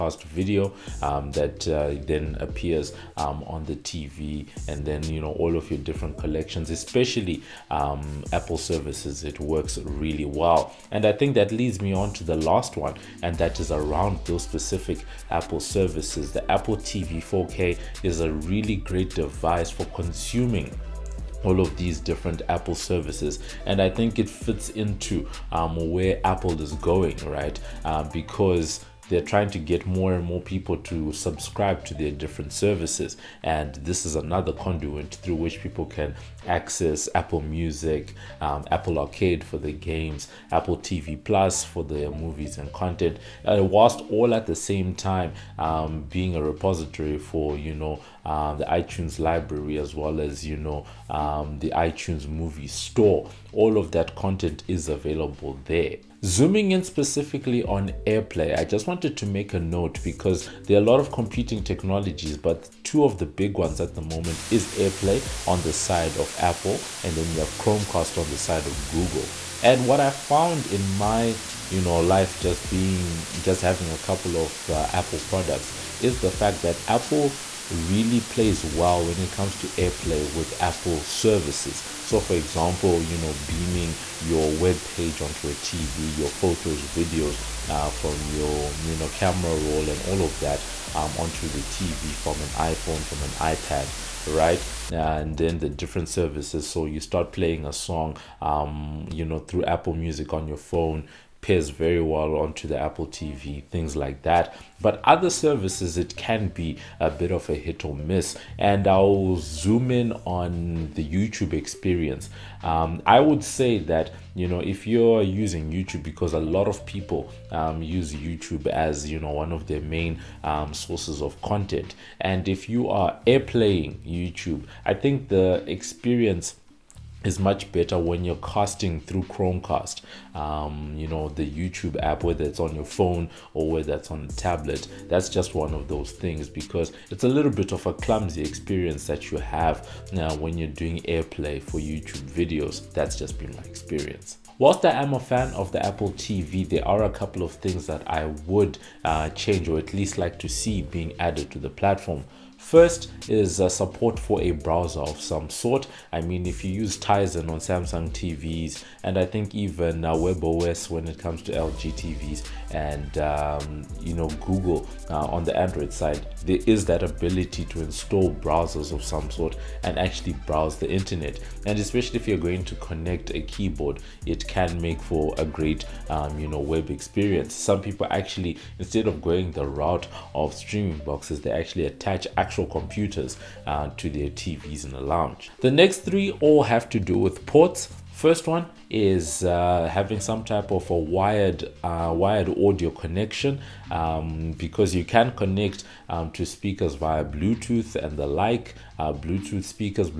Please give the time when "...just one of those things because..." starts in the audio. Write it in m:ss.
2:15.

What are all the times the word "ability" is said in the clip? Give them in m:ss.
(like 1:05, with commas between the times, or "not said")
2:47.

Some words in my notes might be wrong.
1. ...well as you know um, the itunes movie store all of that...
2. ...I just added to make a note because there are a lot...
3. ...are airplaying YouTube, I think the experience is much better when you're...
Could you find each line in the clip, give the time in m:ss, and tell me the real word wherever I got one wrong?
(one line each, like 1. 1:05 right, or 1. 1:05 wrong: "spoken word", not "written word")
1. 0:49 right
2. 0:58 wrong: "wanted", not "added"
3. 2:02 right.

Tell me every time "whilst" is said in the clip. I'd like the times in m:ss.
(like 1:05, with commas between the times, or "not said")
0:43, 2:24.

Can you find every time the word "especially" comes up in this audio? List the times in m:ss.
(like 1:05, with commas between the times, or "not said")
0:06, 2:51.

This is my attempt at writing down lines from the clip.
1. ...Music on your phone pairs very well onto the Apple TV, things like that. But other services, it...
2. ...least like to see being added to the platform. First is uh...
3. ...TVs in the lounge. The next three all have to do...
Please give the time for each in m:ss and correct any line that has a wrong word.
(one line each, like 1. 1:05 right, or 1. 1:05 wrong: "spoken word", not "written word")
1. 1:39 right
2. 2:29 right
3. 3:04 right.